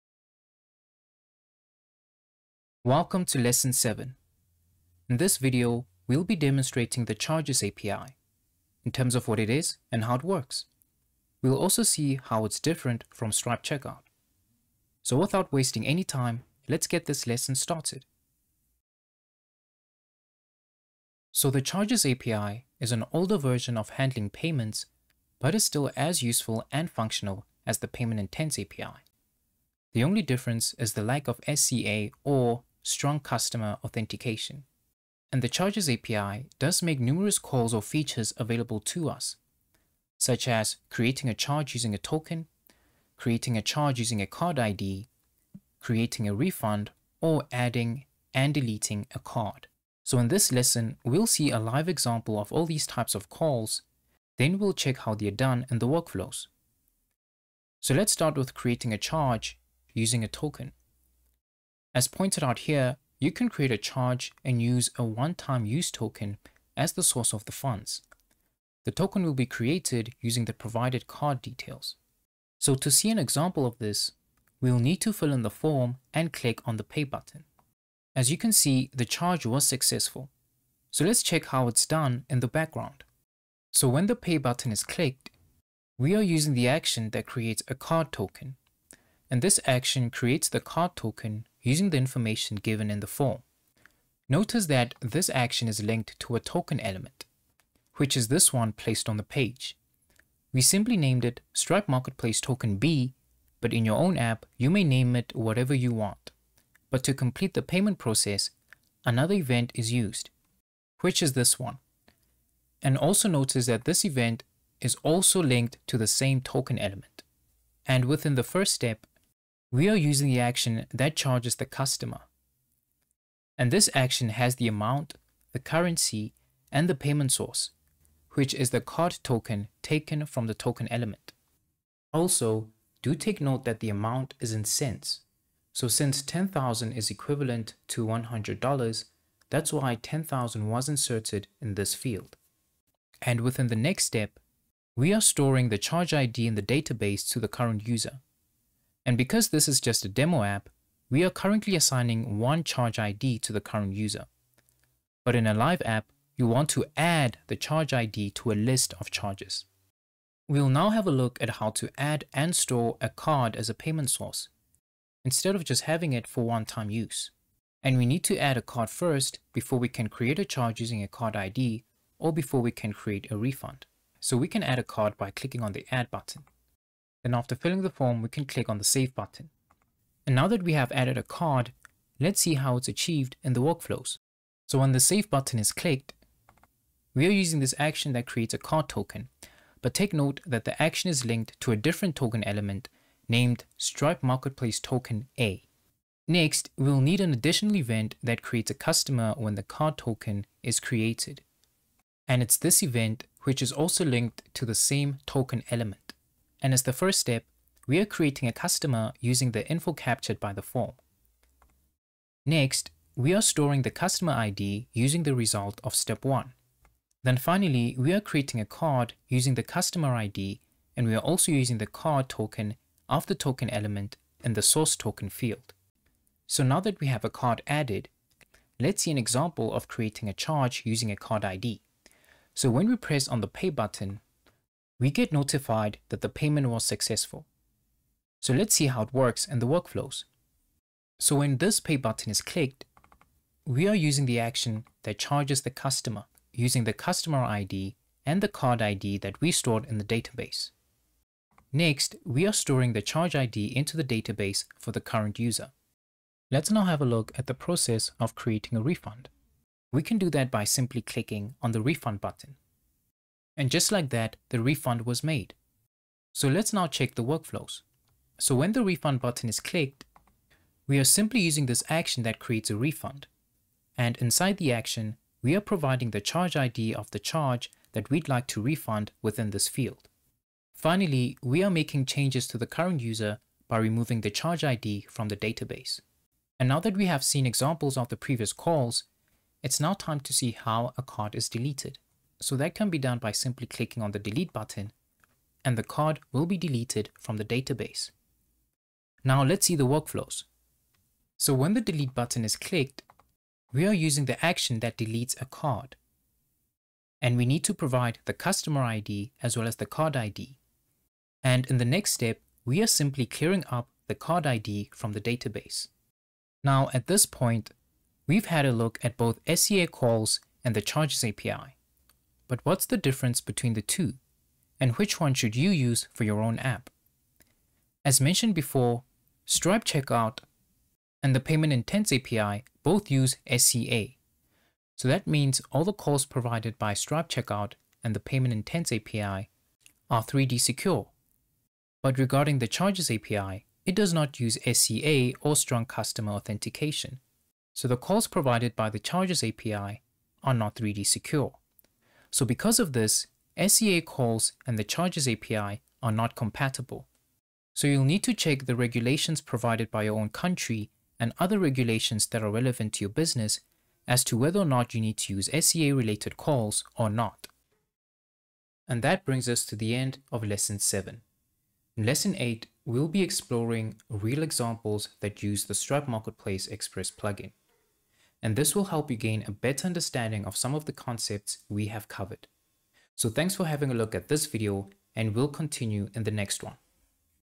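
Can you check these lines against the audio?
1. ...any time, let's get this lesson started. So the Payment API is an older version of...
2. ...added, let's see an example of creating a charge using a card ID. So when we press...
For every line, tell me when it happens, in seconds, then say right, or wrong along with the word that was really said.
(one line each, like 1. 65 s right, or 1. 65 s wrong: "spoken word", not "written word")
1. 15 s wrong: "Charges", not "Payment"
2. 227 s right.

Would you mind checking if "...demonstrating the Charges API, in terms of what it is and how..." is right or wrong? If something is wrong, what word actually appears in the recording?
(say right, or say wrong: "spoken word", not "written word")
right.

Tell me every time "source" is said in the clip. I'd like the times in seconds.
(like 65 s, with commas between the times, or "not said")
67 s, 127 s, 164 s, 224 s.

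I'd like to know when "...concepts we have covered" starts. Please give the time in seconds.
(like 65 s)
380 s.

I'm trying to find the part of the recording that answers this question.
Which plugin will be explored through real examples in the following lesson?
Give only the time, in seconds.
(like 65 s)
375 s.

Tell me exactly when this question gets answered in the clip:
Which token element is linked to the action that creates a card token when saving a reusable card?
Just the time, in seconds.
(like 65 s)
193 s.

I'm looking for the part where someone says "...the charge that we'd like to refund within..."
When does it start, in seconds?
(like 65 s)
277 s.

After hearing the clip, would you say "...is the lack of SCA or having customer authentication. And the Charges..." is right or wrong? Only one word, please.
wrong.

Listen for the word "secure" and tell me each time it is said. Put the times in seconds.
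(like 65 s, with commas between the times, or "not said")
340 s, 351 s.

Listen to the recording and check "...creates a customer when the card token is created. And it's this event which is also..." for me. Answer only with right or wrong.
right.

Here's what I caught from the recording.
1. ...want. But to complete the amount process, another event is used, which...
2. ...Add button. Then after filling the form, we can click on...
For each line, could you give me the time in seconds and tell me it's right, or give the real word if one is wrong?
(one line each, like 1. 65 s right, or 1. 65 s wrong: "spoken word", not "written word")
1. 105 s wrong: "payment", not "amount"
2. 175 s right.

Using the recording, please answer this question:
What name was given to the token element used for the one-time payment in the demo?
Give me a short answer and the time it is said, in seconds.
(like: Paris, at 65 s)
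Stripe Marketplace Token B, at 101 s.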